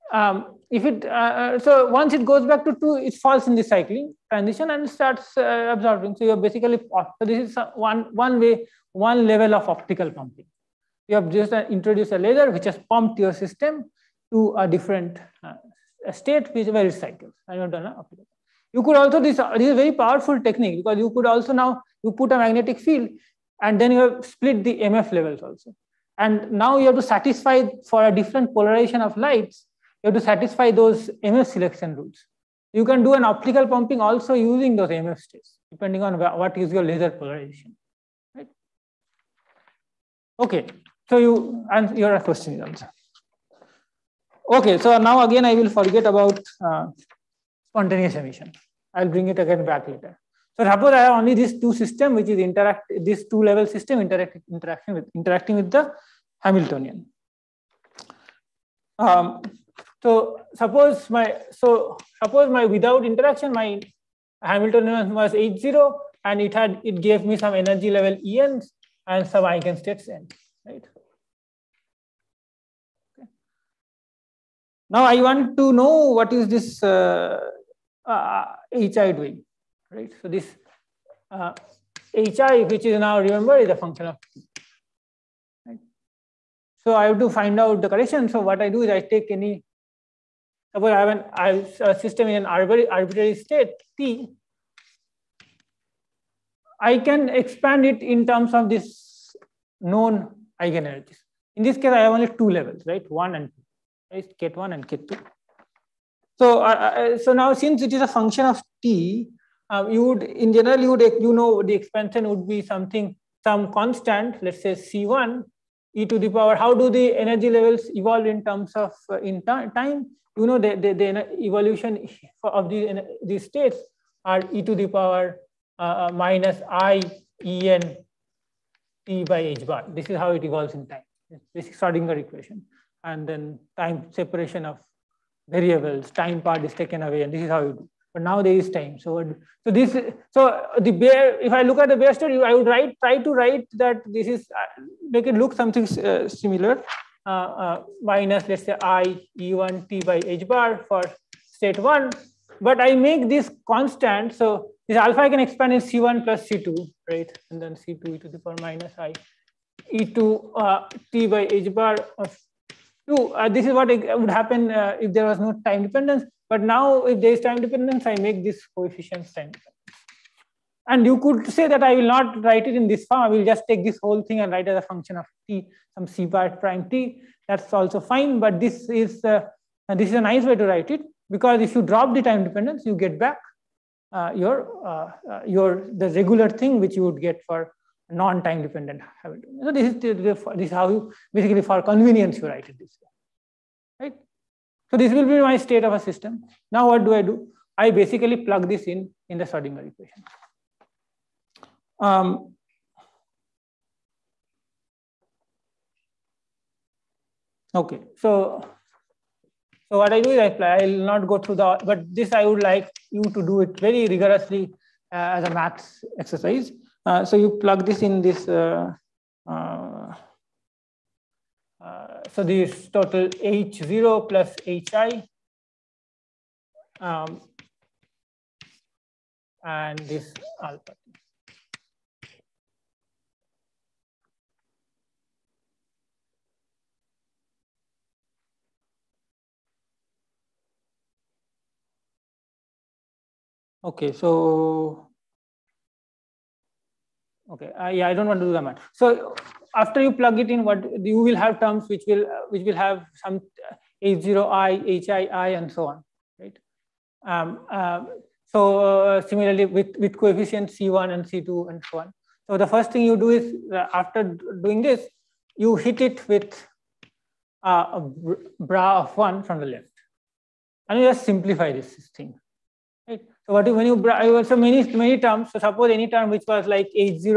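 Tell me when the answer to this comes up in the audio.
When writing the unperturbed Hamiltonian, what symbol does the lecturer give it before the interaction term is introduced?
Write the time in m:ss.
1:05.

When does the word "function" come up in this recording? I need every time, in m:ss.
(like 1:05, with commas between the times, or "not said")
1:23, 1:48, 2:54.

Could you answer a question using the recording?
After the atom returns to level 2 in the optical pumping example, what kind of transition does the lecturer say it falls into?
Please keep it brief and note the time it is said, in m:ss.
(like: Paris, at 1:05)
cycling transition, at 0:03.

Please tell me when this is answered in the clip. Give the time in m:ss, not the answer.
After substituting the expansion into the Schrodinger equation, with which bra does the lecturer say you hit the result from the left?
4:28.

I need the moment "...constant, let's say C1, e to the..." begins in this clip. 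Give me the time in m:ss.
1:53.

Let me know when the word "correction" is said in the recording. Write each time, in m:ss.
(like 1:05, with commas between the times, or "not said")
1:27.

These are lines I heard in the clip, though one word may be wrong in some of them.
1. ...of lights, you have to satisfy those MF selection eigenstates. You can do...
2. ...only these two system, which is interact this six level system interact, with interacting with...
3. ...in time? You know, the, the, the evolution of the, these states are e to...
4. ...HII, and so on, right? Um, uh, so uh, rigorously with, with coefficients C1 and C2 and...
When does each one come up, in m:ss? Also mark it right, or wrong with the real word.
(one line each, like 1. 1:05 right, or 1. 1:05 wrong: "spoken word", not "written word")
1. 0:29 wrong: "rules", not "eigenstates"
2. 0:51 wrong: "two", not "six"
3. 1:59 right
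4. 4:15 wrong: "similarly", not "rigorously".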